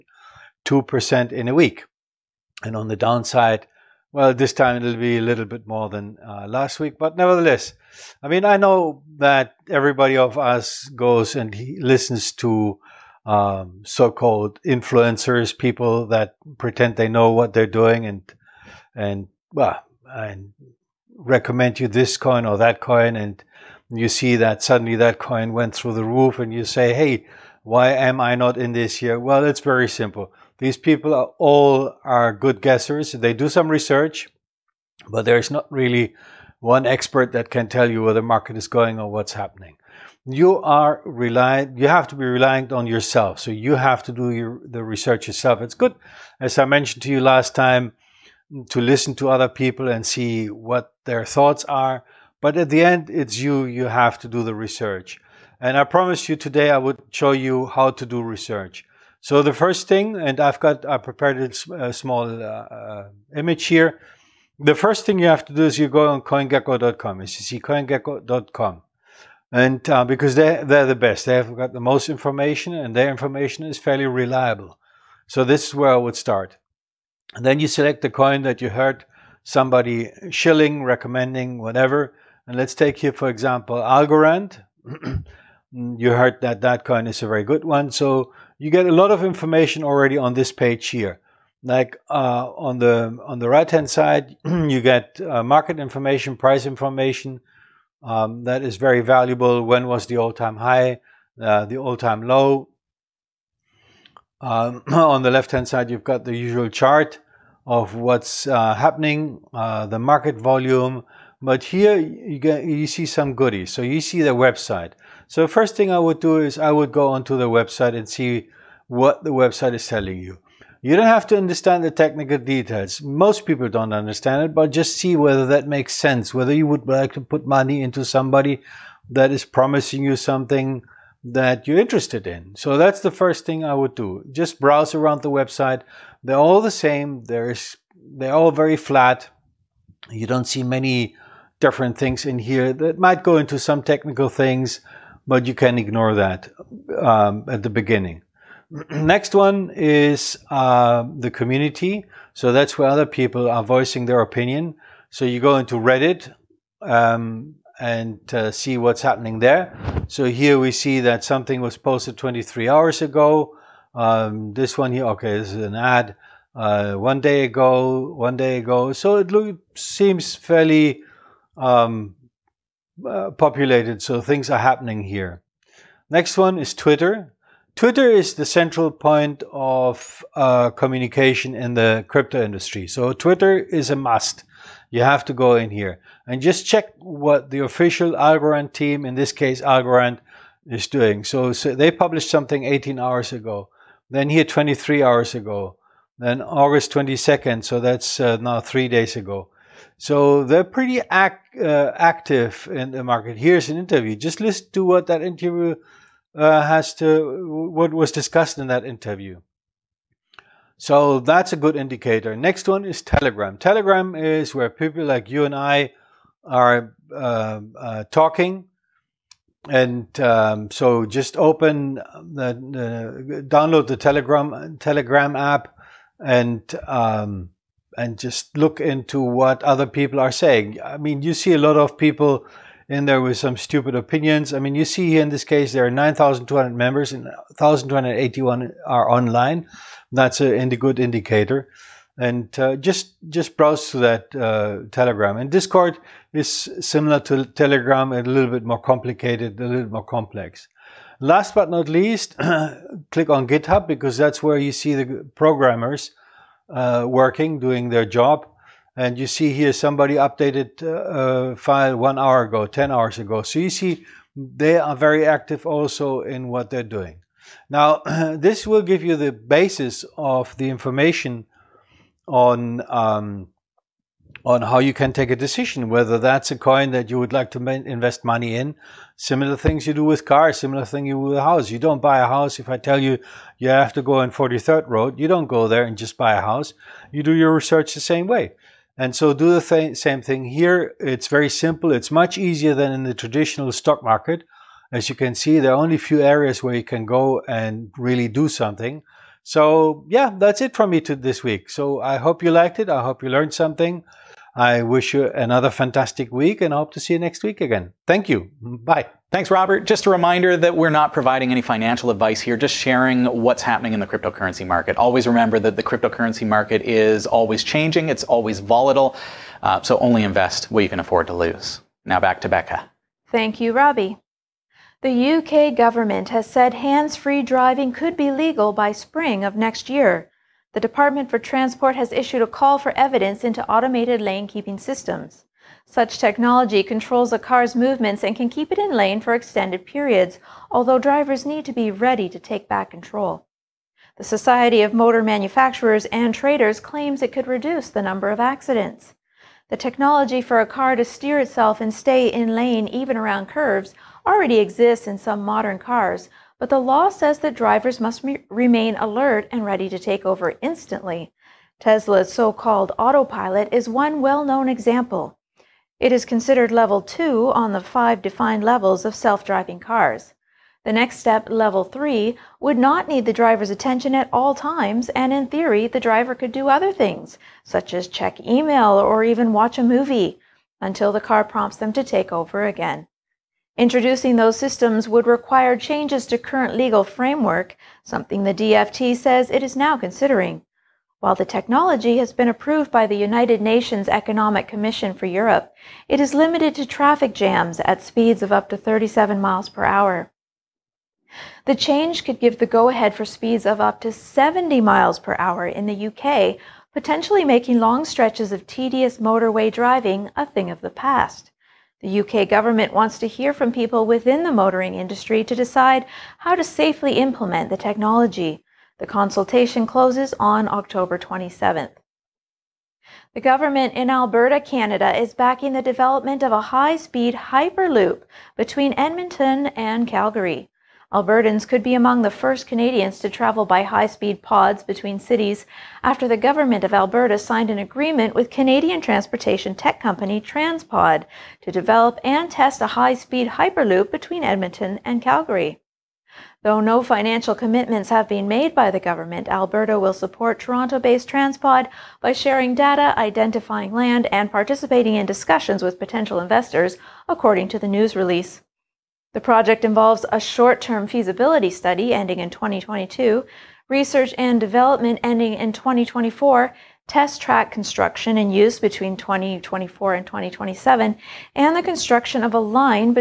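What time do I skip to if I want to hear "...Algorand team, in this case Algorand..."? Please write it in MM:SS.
03:08.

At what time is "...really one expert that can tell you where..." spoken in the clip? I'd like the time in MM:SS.
00:35.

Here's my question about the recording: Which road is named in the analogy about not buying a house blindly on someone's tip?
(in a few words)
43rd Road.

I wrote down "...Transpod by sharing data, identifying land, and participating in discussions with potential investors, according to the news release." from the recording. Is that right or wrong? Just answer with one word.
right.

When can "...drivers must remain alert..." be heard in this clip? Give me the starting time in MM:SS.
05:57.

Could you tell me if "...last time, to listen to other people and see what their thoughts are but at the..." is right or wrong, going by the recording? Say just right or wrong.
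right.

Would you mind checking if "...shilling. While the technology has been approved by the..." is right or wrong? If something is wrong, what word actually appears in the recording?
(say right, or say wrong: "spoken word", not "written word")
wrong: "considering", not "shilling".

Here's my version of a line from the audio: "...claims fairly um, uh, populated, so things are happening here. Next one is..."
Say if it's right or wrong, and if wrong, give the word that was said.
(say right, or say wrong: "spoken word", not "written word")
wrong: "seems", not "claims".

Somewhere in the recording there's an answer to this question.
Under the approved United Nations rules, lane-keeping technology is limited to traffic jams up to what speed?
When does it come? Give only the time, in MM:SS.
06:38.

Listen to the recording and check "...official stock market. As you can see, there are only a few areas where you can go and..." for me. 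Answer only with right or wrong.
wrong.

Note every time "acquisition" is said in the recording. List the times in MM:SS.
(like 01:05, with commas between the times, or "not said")
not said.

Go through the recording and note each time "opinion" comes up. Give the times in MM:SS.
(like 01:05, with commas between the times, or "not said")
02:34, 03:53.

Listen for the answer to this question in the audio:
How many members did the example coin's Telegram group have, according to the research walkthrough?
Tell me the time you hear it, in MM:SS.
03:55.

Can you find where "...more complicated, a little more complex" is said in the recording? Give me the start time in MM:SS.
04:08.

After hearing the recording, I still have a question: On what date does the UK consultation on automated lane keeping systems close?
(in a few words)
October 27th.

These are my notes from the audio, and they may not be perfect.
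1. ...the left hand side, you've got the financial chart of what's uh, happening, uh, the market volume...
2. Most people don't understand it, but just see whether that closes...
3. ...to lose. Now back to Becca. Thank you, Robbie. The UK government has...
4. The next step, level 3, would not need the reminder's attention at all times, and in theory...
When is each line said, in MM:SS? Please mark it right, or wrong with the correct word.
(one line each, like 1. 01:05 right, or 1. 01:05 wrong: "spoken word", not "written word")
1. 01:45 wrong: "usual", not "financial"
2. 02:03 wrong: "makes", not "closes"
3. 05:21 right
4. 06:10 wrong: "driver", not "reminder".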